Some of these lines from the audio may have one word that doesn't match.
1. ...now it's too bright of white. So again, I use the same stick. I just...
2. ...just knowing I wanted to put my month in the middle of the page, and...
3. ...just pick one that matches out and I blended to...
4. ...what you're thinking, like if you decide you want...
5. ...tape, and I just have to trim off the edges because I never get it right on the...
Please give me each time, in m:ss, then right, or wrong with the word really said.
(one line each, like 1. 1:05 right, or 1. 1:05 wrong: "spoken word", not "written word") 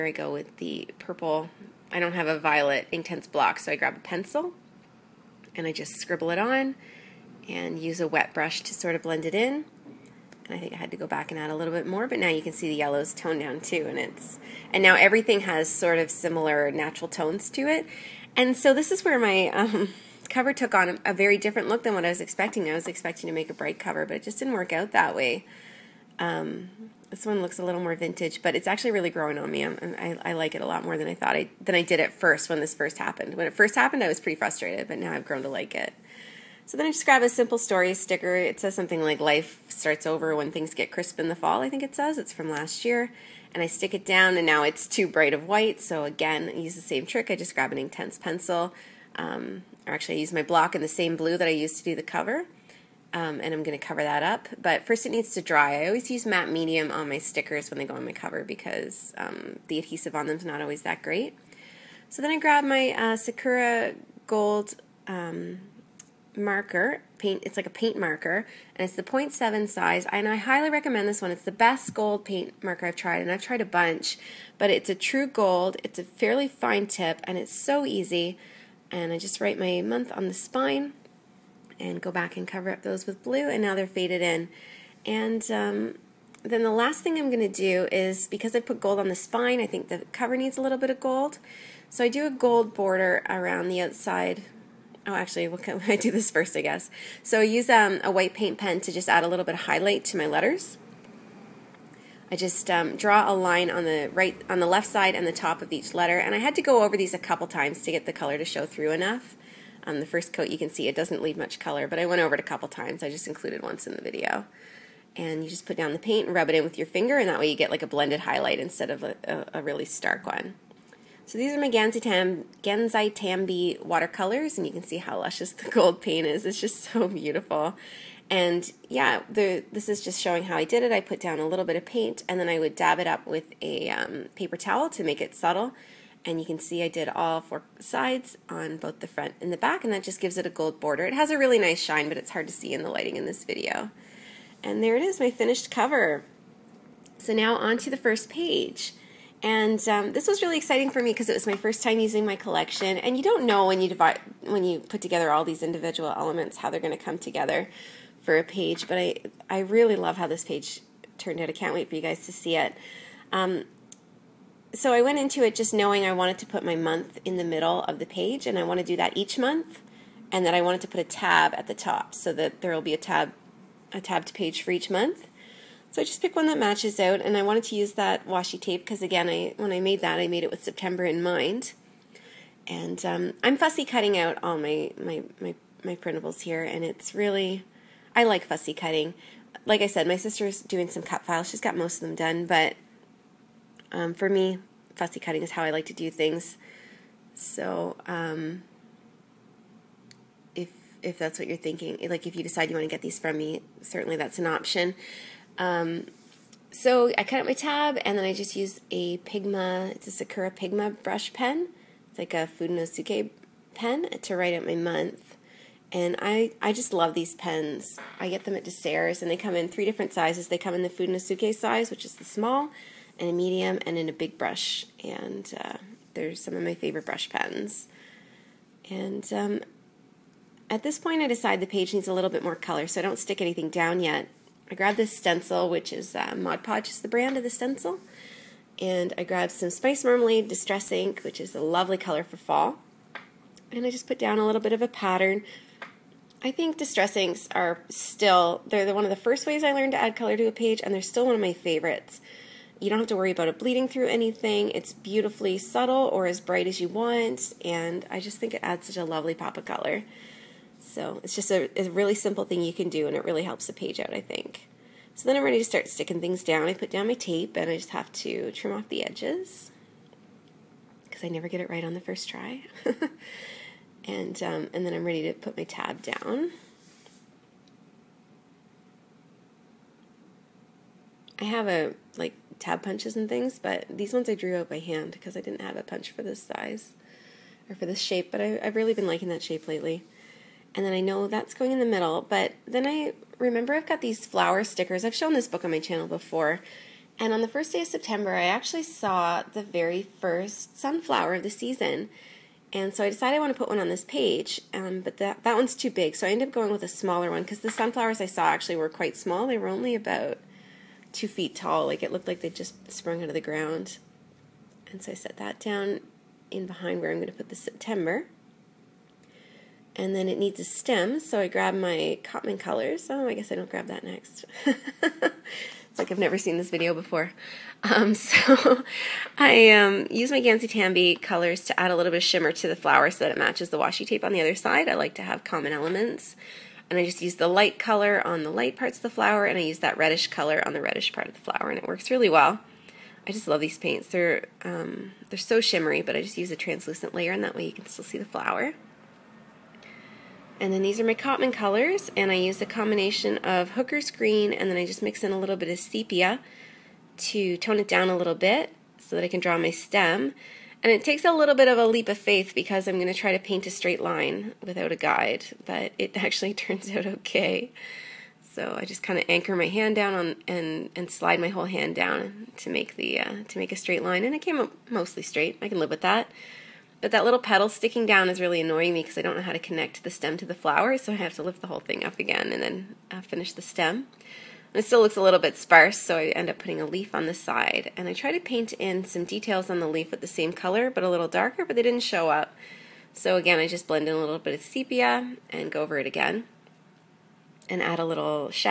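1. 0:44 wrong: "trick", not "stick"
2. 2:45 right
3. 2:56 wrong: "wanted", not "blended"
4. 3:21 right
5. 4:27 right.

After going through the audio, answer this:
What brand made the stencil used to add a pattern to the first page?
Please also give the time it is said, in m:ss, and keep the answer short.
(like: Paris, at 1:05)
Mod Podge, at 3:56.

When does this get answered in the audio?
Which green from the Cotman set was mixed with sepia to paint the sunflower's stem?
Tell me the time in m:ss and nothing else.
5:53.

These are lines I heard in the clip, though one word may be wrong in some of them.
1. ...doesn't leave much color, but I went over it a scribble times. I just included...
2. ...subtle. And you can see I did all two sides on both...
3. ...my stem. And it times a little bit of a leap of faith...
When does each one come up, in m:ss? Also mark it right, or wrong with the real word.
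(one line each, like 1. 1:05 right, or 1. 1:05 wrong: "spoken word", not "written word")
1. 1:50 wrong: "couple", not "scribble"
2. 2:15 wrong: "four", not "two"
3. 5:59 wrong: "takes", not "times".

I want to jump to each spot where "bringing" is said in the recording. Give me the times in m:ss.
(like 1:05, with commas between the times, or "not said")
not said.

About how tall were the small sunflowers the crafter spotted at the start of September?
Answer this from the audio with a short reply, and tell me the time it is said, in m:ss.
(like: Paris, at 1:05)
2 feet, at 5:11.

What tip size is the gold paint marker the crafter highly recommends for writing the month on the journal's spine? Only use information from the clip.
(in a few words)
0.7.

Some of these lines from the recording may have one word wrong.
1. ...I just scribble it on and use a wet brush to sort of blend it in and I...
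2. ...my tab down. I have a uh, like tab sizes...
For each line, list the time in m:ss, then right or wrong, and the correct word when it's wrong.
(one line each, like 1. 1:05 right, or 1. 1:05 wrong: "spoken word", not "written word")
1. 0:05 right
2. 4:35 wrong: "punches", not "sizes".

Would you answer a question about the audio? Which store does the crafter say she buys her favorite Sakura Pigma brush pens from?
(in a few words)
DeSerres.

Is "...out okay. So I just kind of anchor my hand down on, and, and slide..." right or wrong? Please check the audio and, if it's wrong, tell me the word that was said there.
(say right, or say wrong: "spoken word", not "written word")
right.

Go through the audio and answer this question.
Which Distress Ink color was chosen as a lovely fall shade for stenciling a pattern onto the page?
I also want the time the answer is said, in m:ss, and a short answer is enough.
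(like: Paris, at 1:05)
Spice Marmalade, at 3:59.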